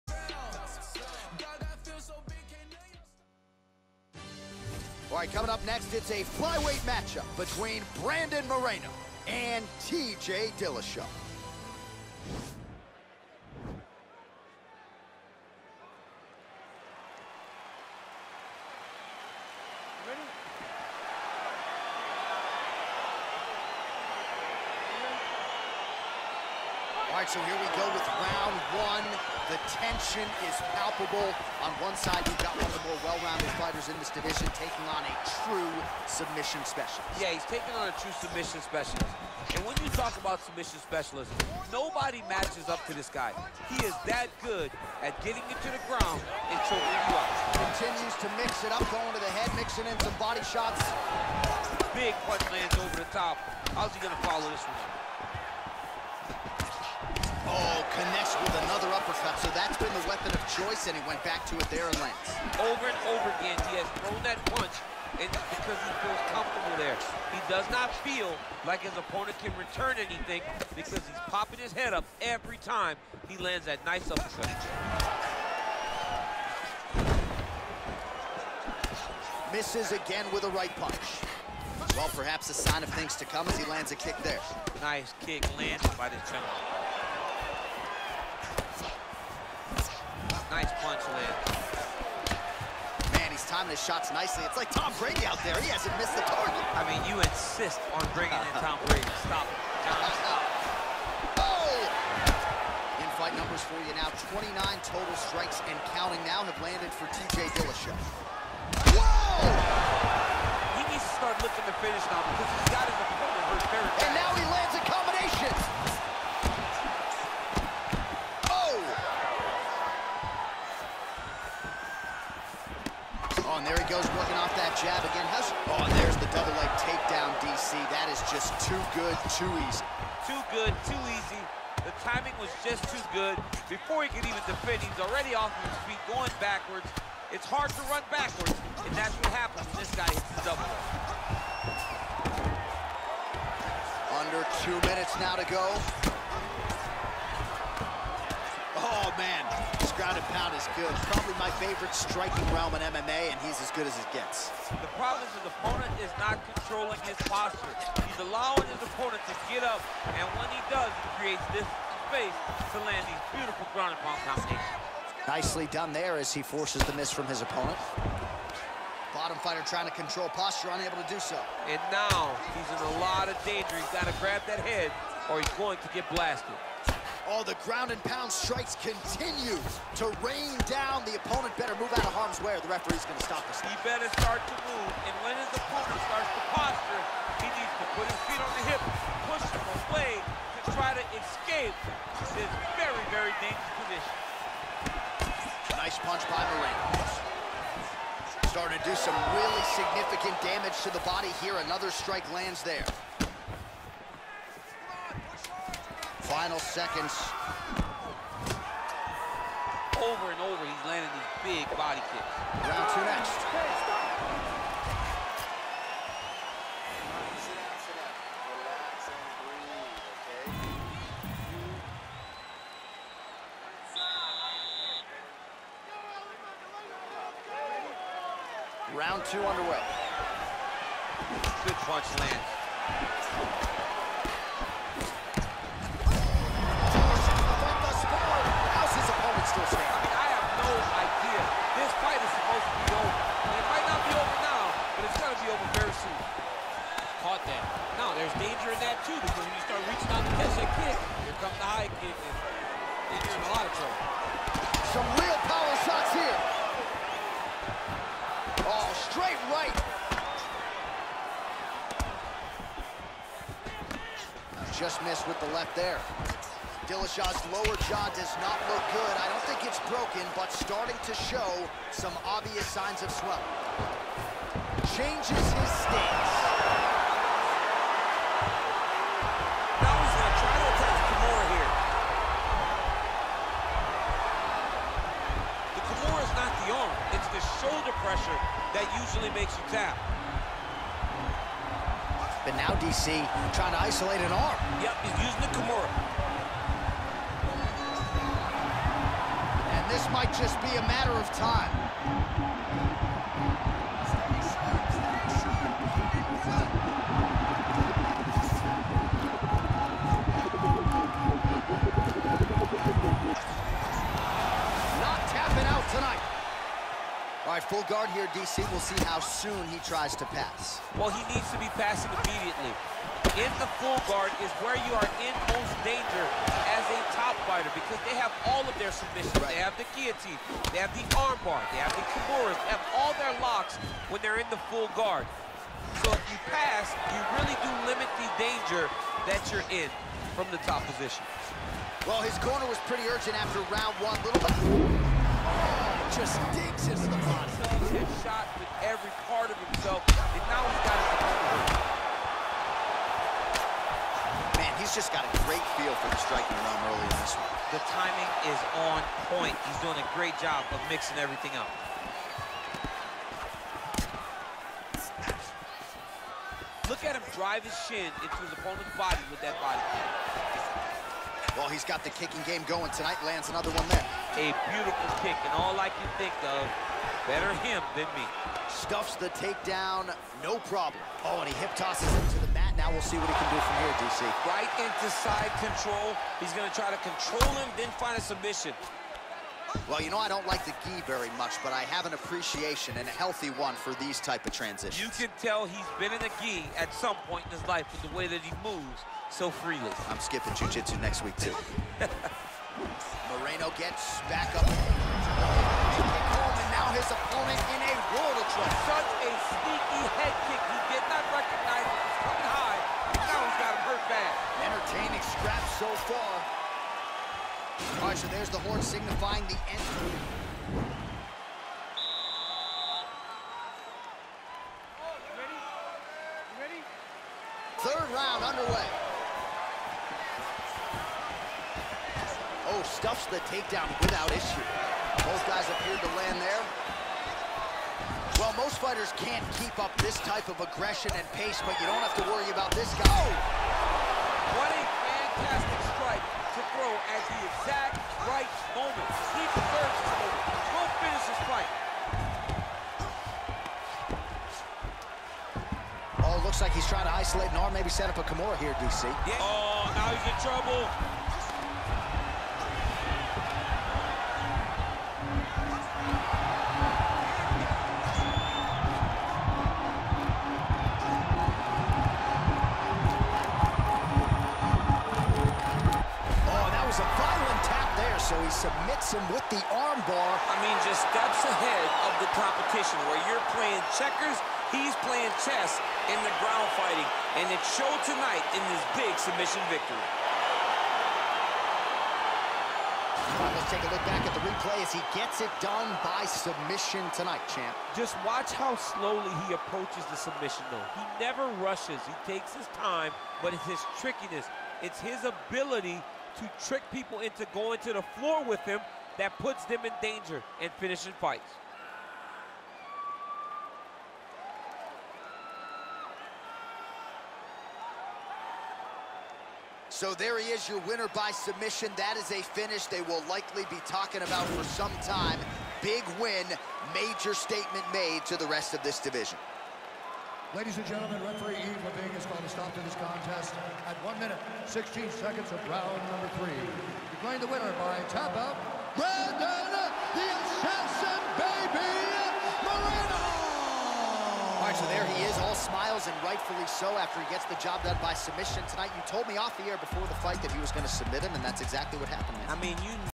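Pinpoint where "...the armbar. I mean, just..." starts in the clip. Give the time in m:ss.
7:59.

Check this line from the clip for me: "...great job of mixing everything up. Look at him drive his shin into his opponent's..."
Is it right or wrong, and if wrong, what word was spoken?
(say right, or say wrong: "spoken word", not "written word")
right.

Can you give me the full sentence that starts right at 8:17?
Just watch how slowly he approaches the submission, though.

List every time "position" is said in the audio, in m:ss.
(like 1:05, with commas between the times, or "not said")
3:13, 5:40.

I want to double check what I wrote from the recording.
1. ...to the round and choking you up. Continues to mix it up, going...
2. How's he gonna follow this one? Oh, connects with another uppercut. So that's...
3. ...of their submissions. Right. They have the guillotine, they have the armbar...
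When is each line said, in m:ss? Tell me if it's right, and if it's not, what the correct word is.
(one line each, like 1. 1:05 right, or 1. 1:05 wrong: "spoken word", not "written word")
1. 0:45 wrong: "ground", not "round"
2. 0:53 right
3. 5:28 right.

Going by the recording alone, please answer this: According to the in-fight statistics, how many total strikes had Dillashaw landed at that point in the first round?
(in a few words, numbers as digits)
29.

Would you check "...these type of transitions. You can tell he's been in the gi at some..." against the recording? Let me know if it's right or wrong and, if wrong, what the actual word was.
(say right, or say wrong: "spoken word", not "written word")
right.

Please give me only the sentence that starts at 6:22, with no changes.
Now we'll see what he can do from here, DC.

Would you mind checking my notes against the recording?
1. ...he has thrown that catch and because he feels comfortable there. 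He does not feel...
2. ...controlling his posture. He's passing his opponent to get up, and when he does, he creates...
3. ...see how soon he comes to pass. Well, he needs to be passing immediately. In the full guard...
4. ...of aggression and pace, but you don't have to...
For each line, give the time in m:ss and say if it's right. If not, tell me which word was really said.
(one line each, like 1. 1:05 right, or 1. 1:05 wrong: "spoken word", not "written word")
1. 1:03 wrong: "punch", not "catch"
2. 2:36 wrong: "allowing", not "passing"
3. 5:18 wrong: "tries", not "comes"
4. 7:20 right.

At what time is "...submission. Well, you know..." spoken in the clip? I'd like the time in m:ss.
6:28.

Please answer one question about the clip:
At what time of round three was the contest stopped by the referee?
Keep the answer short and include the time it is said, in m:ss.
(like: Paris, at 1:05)
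1 minute, 16 seconds, at 8:54.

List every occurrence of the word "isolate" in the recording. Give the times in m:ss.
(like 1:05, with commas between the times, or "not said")
4:53, 7:37.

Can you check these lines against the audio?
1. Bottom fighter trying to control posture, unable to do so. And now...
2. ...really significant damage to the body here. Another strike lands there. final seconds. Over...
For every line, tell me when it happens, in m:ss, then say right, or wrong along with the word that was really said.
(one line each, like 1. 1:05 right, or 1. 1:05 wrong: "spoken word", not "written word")
1. 2:49 right
2. 3:19 right.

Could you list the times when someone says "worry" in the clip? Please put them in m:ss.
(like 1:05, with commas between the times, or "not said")
7:22.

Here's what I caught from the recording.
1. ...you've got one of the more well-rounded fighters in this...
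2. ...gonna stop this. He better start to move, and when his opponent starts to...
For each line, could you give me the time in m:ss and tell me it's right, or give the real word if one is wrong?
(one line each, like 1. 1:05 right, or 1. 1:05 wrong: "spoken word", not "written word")
1. 0:32 right
2. 3:03 right.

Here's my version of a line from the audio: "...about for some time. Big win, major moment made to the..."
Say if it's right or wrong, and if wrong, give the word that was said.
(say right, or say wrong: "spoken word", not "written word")
wrong: "statement", not "moment".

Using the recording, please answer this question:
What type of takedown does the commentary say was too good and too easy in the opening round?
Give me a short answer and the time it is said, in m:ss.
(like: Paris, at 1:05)
Double leg takedown, at 2:06.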